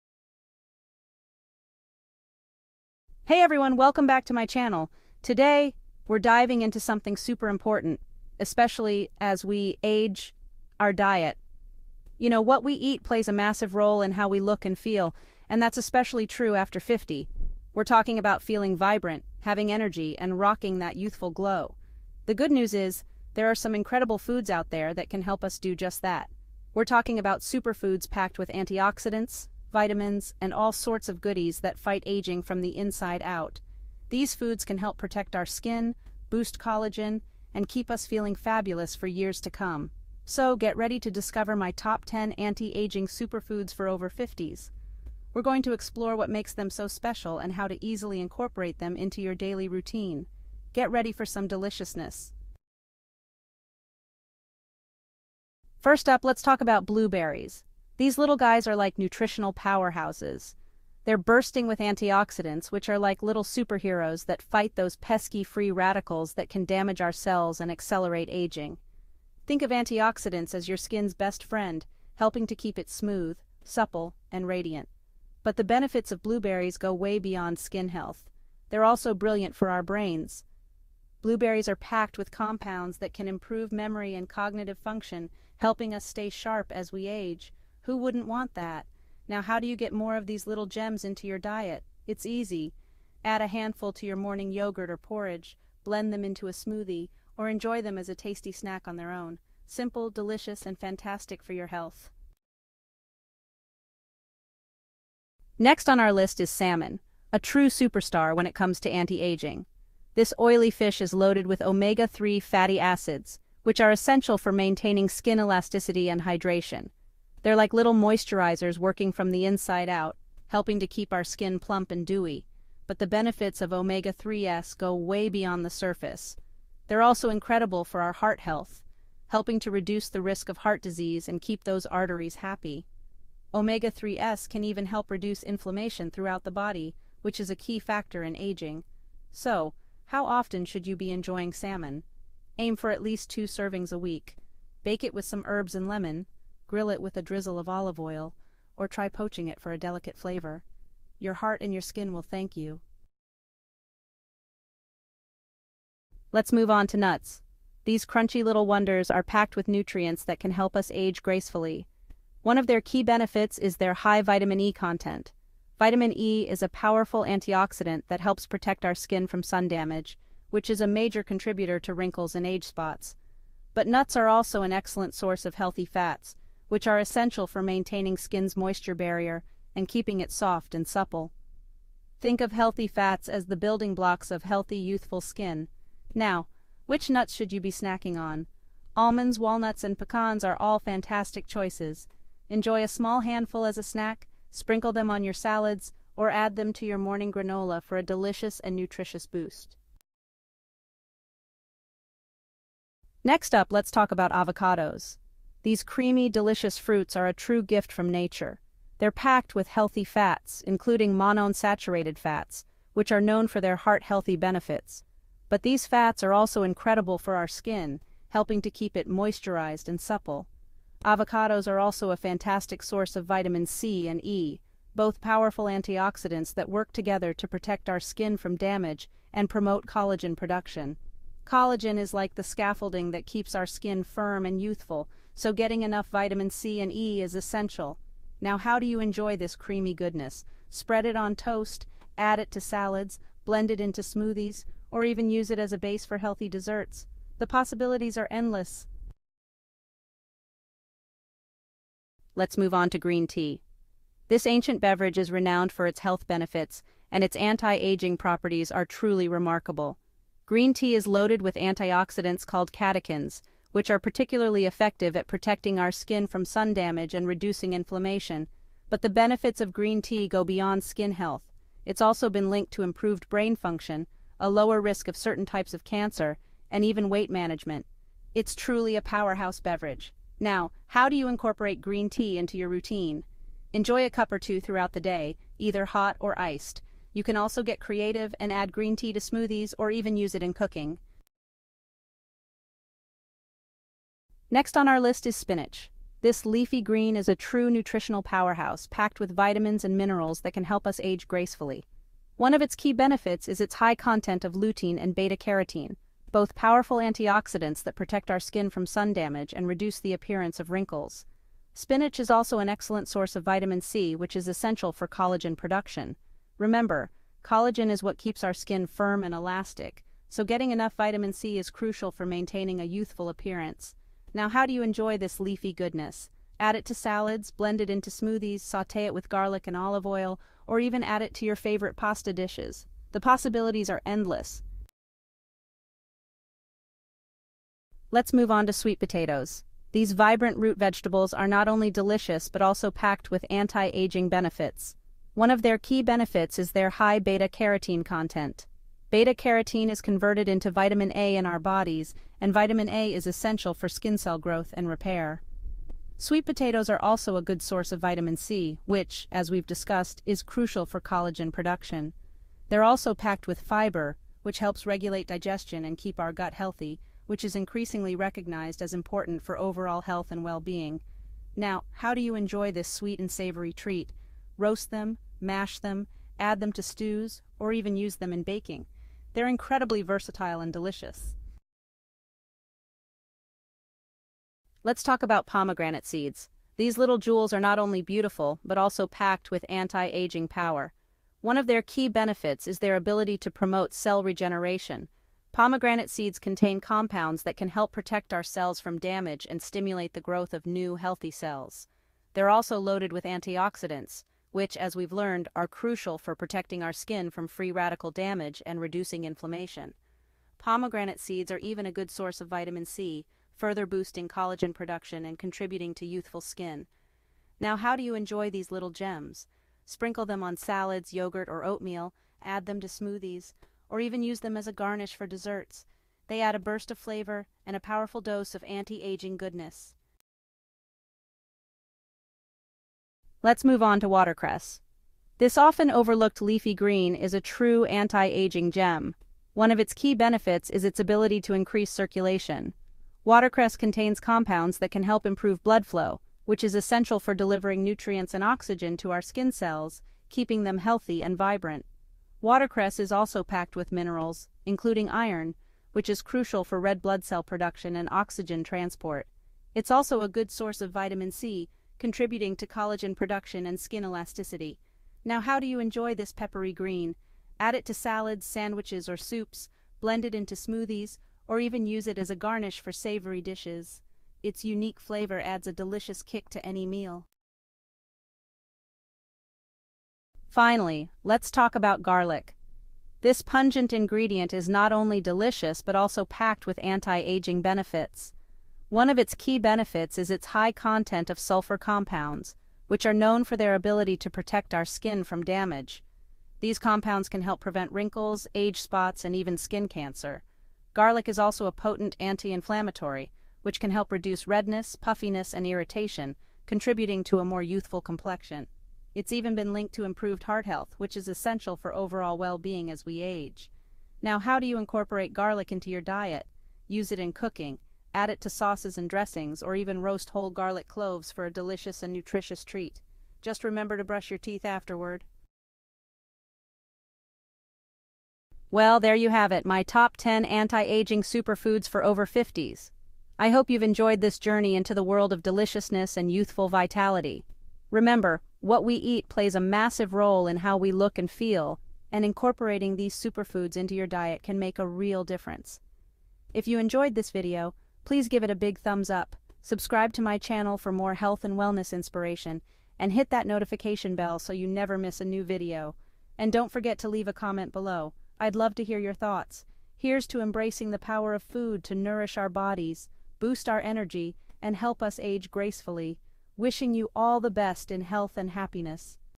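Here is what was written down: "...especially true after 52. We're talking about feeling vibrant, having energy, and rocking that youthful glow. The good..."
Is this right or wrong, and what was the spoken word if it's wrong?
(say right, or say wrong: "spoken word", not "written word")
wrong: "50", not "52".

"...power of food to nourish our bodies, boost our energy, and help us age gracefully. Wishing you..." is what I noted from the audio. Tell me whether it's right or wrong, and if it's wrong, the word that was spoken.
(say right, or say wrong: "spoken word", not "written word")
right.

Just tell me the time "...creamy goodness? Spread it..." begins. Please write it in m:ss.
3:59.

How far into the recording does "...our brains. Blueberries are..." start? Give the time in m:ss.
1:19.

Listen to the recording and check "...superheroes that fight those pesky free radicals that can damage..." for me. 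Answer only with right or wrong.
right.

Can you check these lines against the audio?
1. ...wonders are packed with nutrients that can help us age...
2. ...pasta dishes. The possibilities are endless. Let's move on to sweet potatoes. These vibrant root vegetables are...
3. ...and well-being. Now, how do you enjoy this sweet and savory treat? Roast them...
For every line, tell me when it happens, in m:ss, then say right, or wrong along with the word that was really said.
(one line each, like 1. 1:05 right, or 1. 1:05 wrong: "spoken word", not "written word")
1. 2:38 right
2. 5:31 right
3. 6:10 right.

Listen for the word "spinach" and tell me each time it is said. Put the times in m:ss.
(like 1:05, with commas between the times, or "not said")
4:55, 5:11.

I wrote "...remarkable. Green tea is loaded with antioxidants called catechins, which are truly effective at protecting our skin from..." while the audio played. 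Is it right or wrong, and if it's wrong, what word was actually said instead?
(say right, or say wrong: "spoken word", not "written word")
wrong: "particularly", not "truly".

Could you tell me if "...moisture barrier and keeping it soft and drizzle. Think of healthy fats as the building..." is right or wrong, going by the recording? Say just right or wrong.
wrong.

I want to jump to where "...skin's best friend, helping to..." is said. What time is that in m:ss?
1:10.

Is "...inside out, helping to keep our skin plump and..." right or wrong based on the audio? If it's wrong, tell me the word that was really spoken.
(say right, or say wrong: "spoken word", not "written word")
right.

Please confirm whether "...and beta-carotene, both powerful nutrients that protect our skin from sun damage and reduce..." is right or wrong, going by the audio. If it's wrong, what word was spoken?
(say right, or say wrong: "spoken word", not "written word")
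wrong: "antioxidants", not "nutrients".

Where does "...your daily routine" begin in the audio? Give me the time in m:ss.
0:49.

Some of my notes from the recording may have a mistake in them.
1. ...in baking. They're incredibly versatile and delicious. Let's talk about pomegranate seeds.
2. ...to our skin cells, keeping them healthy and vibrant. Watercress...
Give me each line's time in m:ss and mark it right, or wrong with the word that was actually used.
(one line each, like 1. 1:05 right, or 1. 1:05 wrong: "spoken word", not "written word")
1. 6:18 right
2. 7:28 right.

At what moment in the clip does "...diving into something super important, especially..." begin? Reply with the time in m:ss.
0:06.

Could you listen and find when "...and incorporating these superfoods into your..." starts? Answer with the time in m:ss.
9:02.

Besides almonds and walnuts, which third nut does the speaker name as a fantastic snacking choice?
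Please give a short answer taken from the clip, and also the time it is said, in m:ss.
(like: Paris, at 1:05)
Pecans, at 3:09.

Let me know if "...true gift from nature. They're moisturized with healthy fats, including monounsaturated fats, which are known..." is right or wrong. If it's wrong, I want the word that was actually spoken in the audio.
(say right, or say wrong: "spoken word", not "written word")
wrong: "packed", not "moisturized".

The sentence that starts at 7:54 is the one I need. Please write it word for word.
Its unique flavor adds a delicious kick to any meal.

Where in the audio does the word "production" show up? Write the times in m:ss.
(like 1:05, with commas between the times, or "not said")
3:50, 5:15, 6:01, 6:54, 7:37, 7:43.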